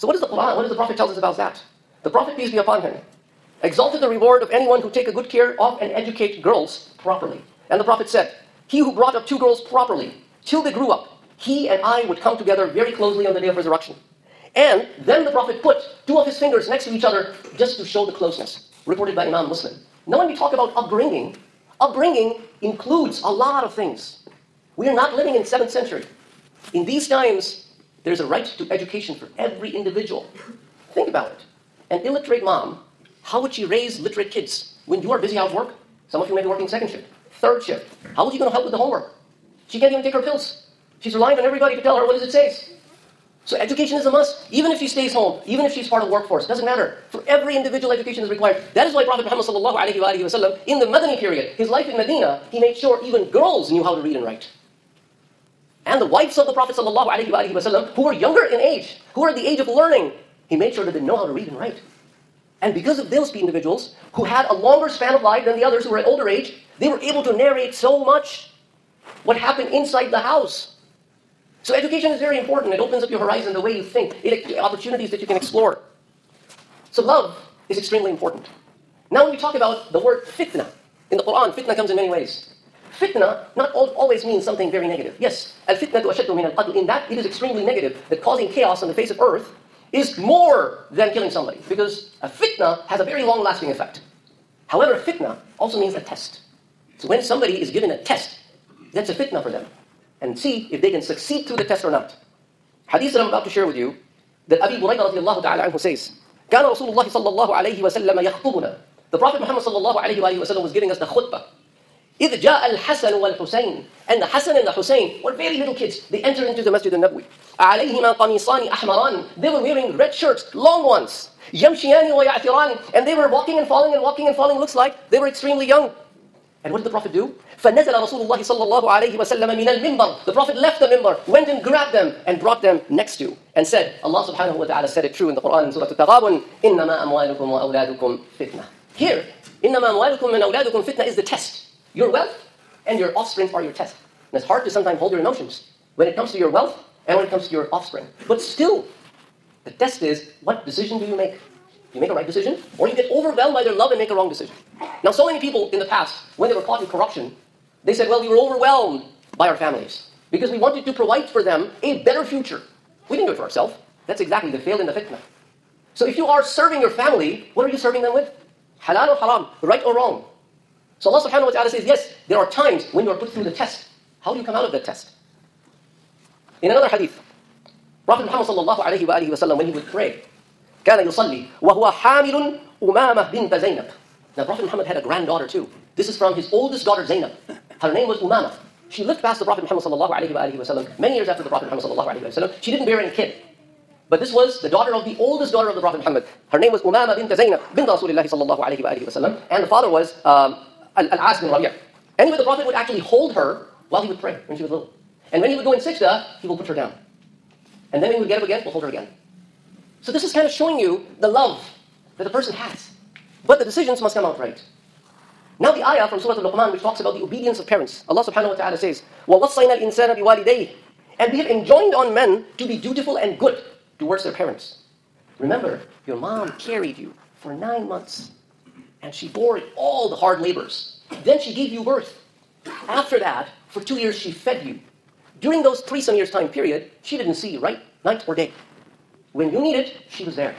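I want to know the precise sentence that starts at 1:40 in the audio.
And see if they can succeed through the test or not.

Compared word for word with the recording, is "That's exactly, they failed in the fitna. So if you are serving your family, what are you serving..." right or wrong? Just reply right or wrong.
right.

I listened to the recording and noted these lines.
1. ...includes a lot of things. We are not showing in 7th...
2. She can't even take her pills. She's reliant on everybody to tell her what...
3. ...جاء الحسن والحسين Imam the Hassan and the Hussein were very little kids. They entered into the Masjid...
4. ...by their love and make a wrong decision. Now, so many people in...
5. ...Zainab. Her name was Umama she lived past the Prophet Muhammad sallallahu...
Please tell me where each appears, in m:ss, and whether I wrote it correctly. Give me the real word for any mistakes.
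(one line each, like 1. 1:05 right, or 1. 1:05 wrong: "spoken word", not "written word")
1. 0:22 wrong: "living", not "showing"
2. 0:39 right
3. 1:52 wrong: "And", not "Imam"
4. 2:33 right
5. 3:07 right.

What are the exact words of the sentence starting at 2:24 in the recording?
And it's hard to sometimes hold your emotions when it comes to your wealth and when it comes to your offspring.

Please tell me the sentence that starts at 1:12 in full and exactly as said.
It opens up your horizon, the way you think, it opportunities that you can explore.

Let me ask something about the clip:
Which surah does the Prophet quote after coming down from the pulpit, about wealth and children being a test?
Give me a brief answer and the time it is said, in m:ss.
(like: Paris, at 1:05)
Surah Al-Taghabun, at 2:15.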